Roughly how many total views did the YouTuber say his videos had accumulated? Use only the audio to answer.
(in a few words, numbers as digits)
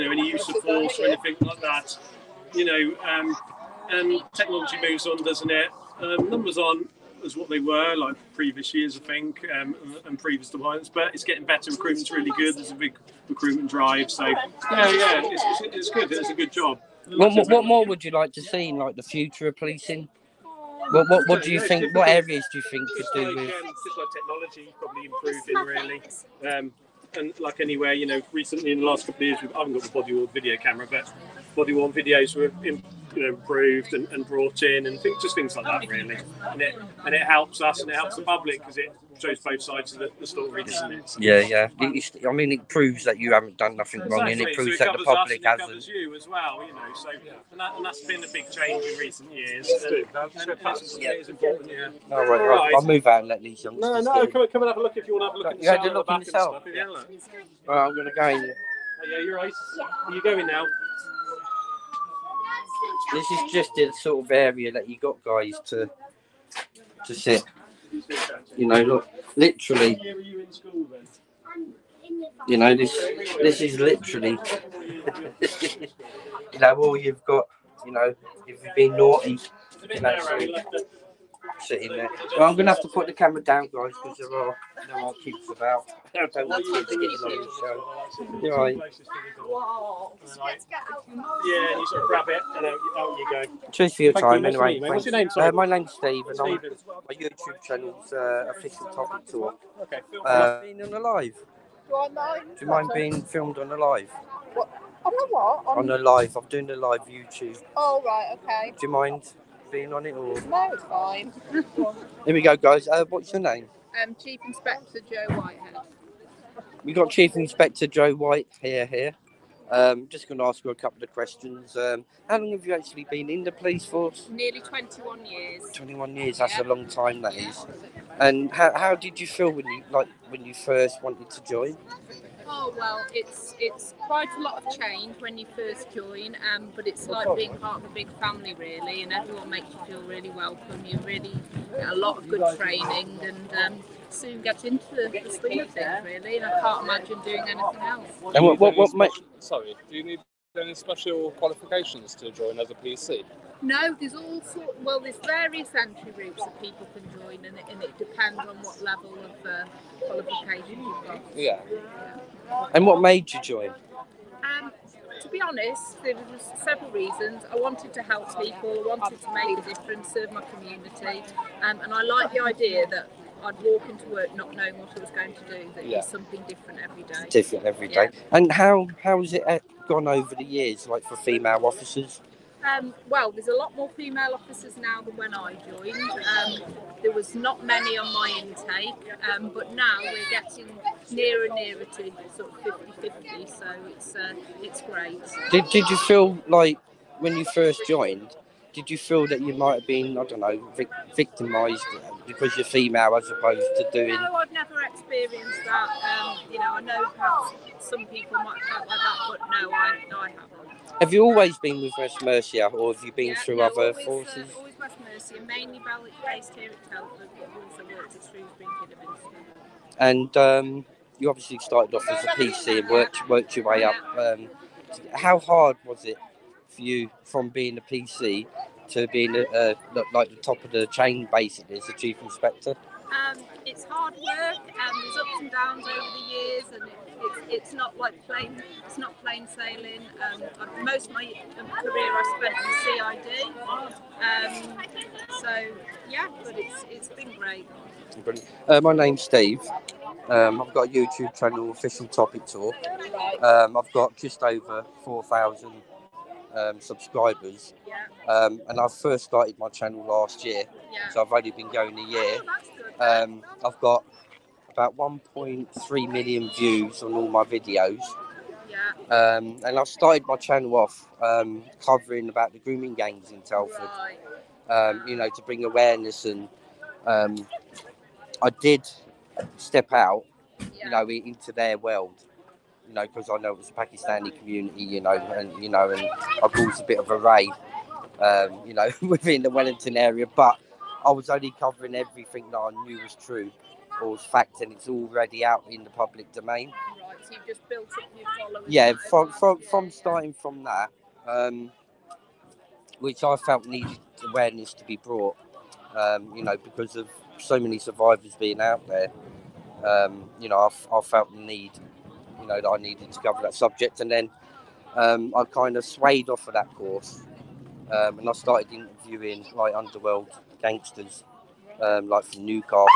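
1.3 million.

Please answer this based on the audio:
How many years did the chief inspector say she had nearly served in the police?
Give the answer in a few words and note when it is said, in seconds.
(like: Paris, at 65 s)
21, at 124 s.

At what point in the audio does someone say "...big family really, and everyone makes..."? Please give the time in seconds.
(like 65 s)
137 s.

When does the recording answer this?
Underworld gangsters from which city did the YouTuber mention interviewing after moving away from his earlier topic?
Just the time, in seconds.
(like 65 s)
322 s.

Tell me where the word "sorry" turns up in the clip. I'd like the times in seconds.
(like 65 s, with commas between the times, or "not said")
95 s, 149 s.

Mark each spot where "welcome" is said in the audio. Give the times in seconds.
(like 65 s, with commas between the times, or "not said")
140 s.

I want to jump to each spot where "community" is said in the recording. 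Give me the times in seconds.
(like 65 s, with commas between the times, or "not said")
170 s, 284 s.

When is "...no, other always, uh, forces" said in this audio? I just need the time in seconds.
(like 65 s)
213 s.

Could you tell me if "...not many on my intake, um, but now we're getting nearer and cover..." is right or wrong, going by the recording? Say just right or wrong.
wrong.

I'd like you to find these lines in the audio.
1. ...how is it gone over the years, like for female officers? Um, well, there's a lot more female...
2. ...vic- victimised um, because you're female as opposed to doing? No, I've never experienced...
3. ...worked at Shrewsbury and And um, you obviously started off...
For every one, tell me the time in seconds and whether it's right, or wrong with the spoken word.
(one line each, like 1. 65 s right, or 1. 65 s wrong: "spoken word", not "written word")
1. 179 s right
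2. 200 s right
3. 217 s right.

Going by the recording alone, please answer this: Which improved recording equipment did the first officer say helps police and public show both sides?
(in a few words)
Body worn video.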